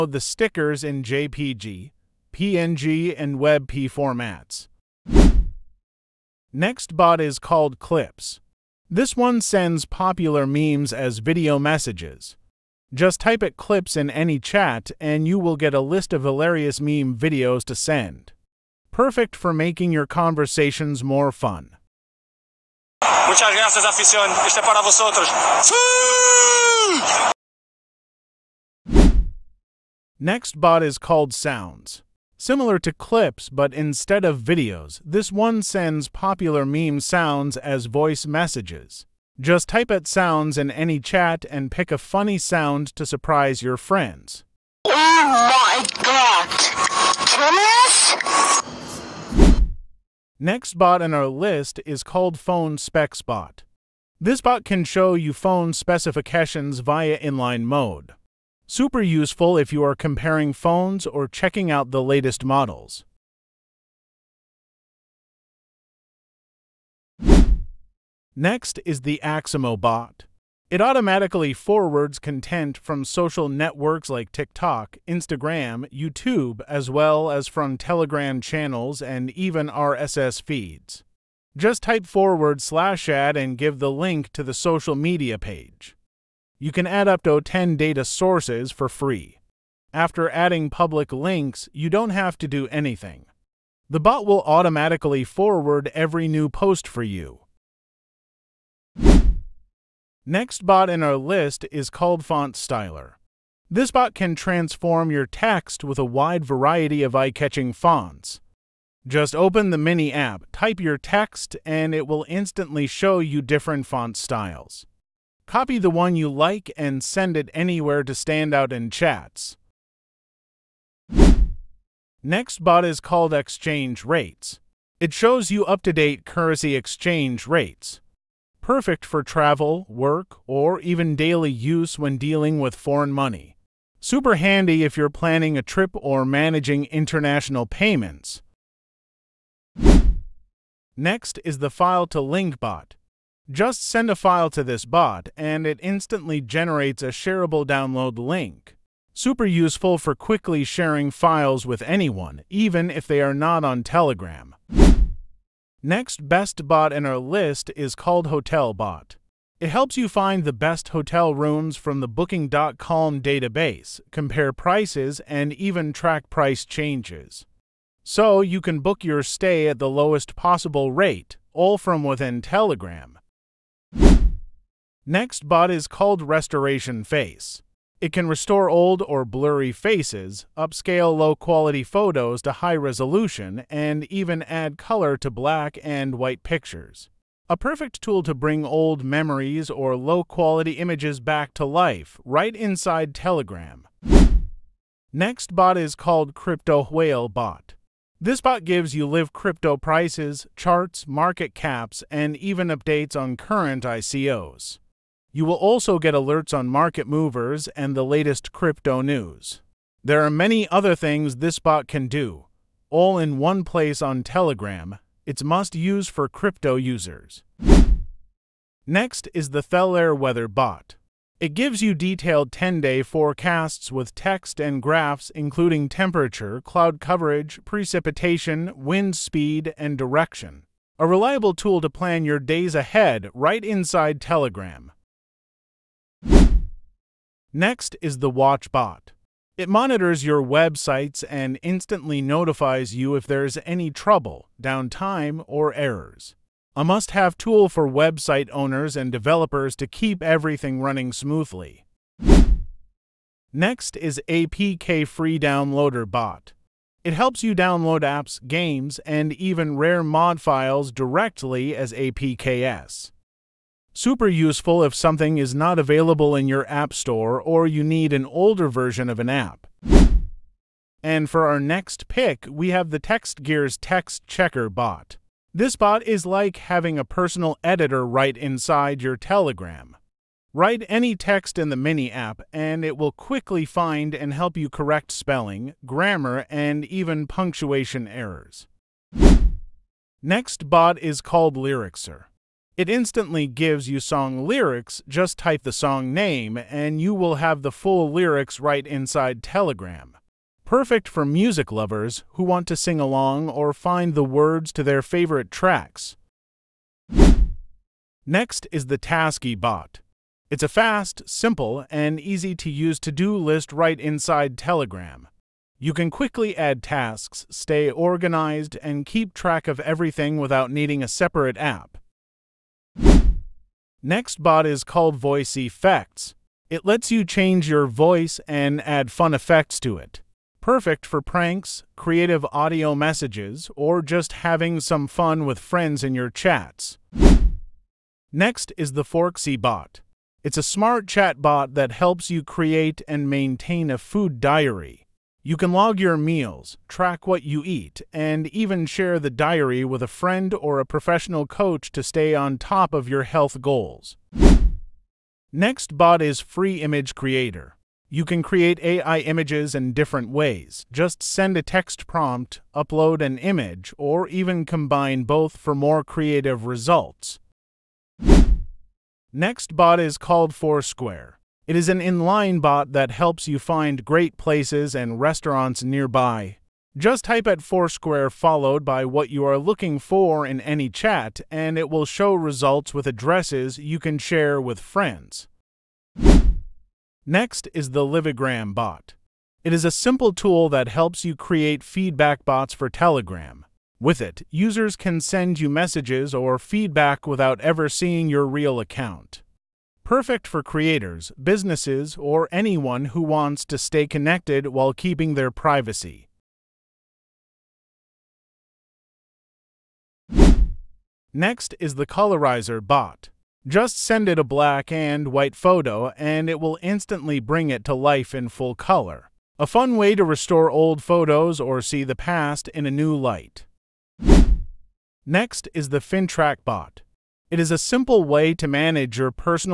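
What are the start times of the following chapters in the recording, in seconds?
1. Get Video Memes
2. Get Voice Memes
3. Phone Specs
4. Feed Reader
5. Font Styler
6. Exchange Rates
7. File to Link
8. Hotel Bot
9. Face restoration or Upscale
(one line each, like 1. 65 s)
1. 5 s
2. 29 s
3. 49 s
4. 67 s
5. 99 s
6. 121 s
7. 140 s
8. 154 s
9. 174 s.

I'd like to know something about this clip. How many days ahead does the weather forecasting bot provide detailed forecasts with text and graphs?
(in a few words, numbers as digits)
10.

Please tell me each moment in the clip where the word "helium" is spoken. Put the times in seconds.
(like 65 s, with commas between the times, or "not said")
not said.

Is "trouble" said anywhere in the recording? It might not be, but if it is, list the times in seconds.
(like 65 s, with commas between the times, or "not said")
243 s.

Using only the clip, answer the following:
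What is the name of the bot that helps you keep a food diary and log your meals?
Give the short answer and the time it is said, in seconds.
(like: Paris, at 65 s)
Forksy, at 339 s.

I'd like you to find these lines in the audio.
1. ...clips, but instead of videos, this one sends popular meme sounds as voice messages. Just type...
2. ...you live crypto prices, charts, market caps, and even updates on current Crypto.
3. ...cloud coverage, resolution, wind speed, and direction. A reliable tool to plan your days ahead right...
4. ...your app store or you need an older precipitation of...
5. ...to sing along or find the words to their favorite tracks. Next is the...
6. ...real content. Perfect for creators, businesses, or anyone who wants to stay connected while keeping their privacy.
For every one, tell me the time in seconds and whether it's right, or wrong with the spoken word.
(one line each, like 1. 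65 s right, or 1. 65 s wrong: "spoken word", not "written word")
1. 32 s right
2. 198 s wrong: "ICOs", not "Crypto"
3. 226 s wrong: "precipitation", not "resolution"
4. 266 s wrong: "version", not "precipitation"
5. 302 s right
6. 398 s wrong: "account", not "content".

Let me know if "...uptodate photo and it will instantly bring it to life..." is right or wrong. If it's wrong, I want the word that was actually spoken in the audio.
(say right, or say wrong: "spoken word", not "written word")
wrong: "white", not "uptodate".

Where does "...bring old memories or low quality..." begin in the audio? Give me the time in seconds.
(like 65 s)
188 s.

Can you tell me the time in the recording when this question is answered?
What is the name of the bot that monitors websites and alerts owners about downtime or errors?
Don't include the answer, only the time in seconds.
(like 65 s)
238 s.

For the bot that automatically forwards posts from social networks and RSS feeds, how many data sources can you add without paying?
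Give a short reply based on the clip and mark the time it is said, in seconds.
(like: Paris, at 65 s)
10, at 87 s.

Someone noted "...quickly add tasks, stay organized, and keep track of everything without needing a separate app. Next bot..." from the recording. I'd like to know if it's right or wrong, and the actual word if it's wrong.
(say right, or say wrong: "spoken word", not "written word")
right.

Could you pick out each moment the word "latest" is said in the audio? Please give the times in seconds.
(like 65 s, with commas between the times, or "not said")
62 s, 208 s.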